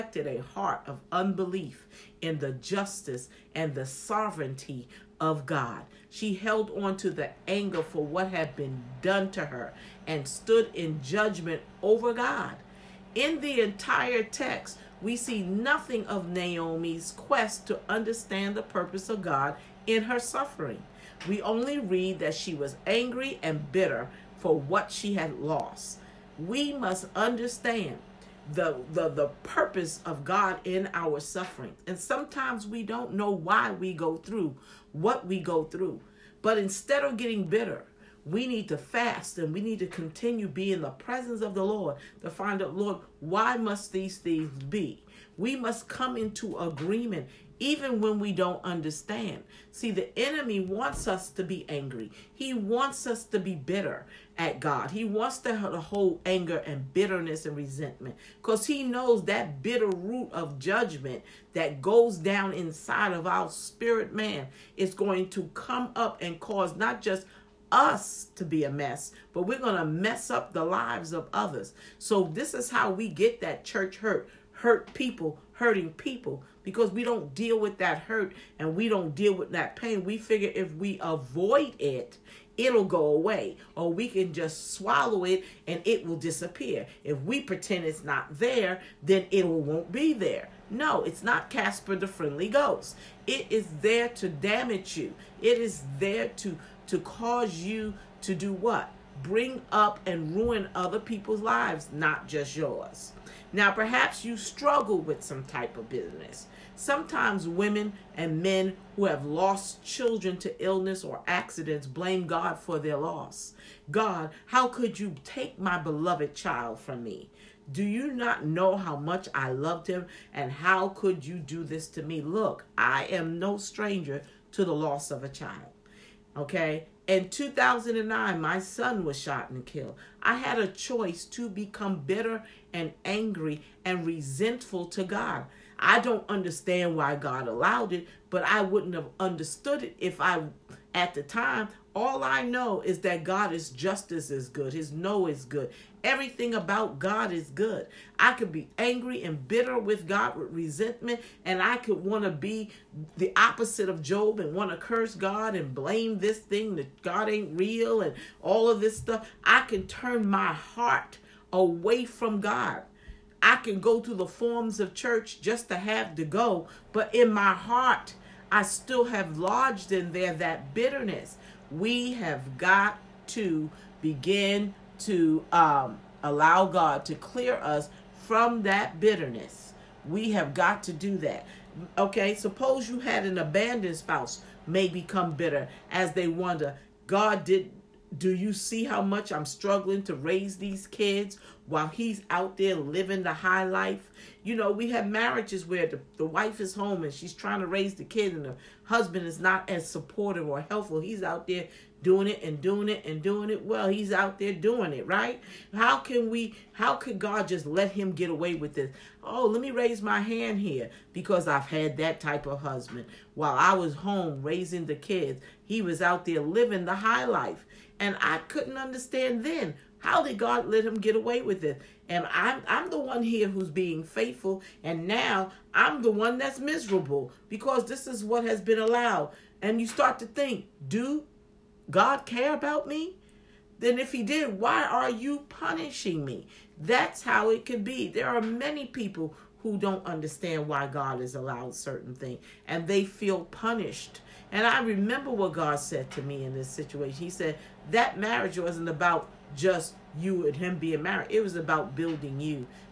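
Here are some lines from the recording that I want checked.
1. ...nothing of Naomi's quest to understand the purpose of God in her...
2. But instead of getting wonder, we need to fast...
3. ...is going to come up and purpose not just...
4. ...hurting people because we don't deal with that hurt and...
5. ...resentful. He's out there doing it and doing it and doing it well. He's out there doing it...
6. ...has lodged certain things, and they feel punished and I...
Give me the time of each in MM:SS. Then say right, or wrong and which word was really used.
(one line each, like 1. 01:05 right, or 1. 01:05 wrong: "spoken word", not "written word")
1. 00:15 right
2. 00:36 wrong: "bitter", not "wonder"
3. 01:04 wrong: "cause", not "purpose"
4. 01:15 right
5. 03:20 wrong: "helpful", not "resentful"
6. 04:01 wrong: "allowed", not "lodged".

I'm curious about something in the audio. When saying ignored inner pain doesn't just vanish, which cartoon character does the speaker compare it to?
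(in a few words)
Casper the Friendly Ghost.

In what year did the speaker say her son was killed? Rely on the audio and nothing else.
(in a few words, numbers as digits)
2009.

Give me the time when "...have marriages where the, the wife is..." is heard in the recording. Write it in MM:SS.
03:14.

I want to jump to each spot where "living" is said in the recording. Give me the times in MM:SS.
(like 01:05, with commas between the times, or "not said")
03:12, 03:36.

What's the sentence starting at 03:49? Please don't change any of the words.
And you start to think, do God care about me?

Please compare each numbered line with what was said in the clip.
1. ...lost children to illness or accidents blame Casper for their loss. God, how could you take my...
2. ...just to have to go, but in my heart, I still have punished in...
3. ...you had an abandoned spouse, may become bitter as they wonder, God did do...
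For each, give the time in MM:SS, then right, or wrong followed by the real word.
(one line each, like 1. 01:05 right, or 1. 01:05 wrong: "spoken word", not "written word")
1. 01:49 wrong: "God", not "Casper"
2. 02:45 wrong: "lodged", not "punished"
3. 03:02 right.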